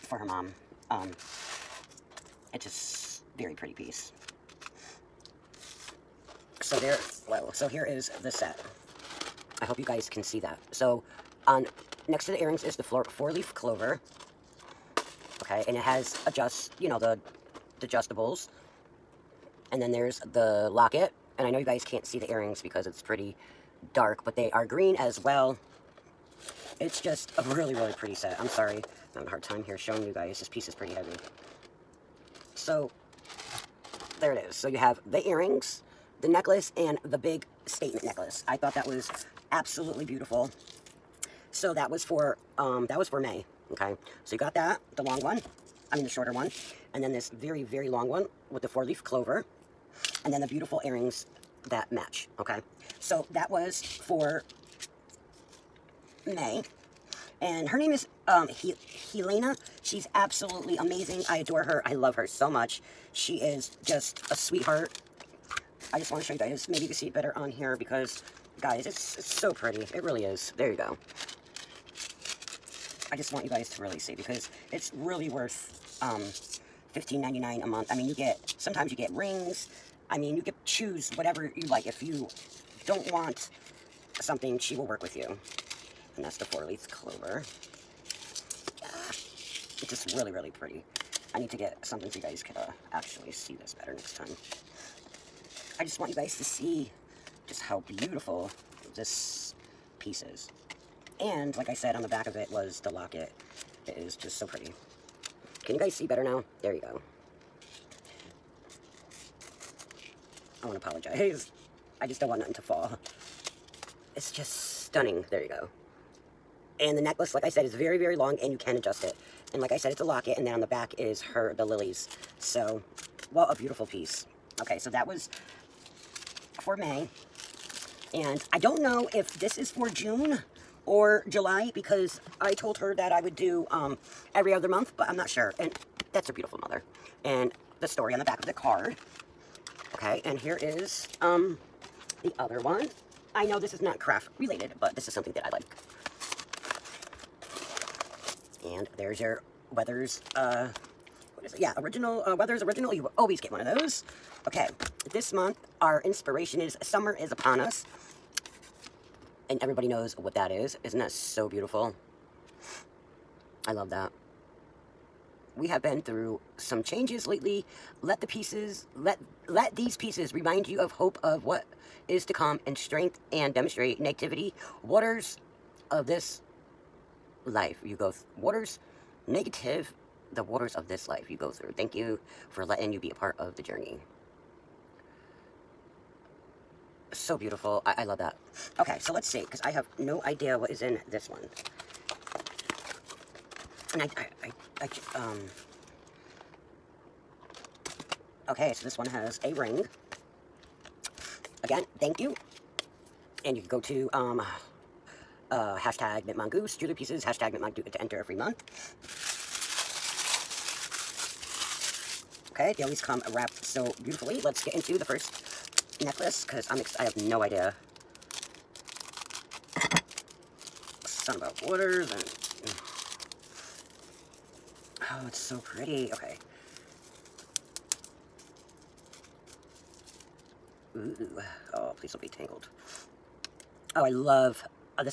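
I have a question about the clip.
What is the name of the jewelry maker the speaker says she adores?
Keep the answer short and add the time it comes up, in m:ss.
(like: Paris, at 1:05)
Helena, at 0:59.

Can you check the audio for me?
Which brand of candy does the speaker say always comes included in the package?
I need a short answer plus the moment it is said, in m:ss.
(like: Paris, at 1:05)
Werther's Original, at 2:32.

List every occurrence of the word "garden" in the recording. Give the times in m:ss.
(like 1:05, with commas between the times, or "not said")
not said.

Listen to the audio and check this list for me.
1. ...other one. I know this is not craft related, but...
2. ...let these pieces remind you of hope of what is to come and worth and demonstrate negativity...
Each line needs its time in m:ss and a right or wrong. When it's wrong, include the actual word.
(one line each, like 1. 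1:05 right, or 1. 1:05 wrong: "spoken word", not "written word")
1. 2:22 right
2. 2:49 wrong: "strength", not "worth".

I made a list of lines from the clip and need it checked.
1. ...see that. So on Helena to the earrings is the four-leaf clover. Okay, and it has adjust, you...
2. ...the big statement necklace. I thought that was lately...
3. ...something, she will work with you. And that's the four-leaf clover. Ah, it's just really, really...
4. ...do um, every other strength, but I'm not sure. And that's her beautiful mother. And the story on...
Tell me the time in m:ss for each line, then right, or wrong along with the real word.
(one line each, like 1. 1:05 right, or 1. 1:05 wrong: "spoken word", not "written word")
1. 0:10 wrong: "Next", not "Helena"
2. 0:37 wrong: "absolutely", not "lately"
3. 1:24 right
4. 2:13 wrong: "month", not "strength".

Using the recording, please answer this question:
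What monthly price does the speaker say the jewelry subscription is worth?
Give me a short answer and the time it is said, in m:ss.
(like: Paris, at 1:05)
$15.99, at 1:16.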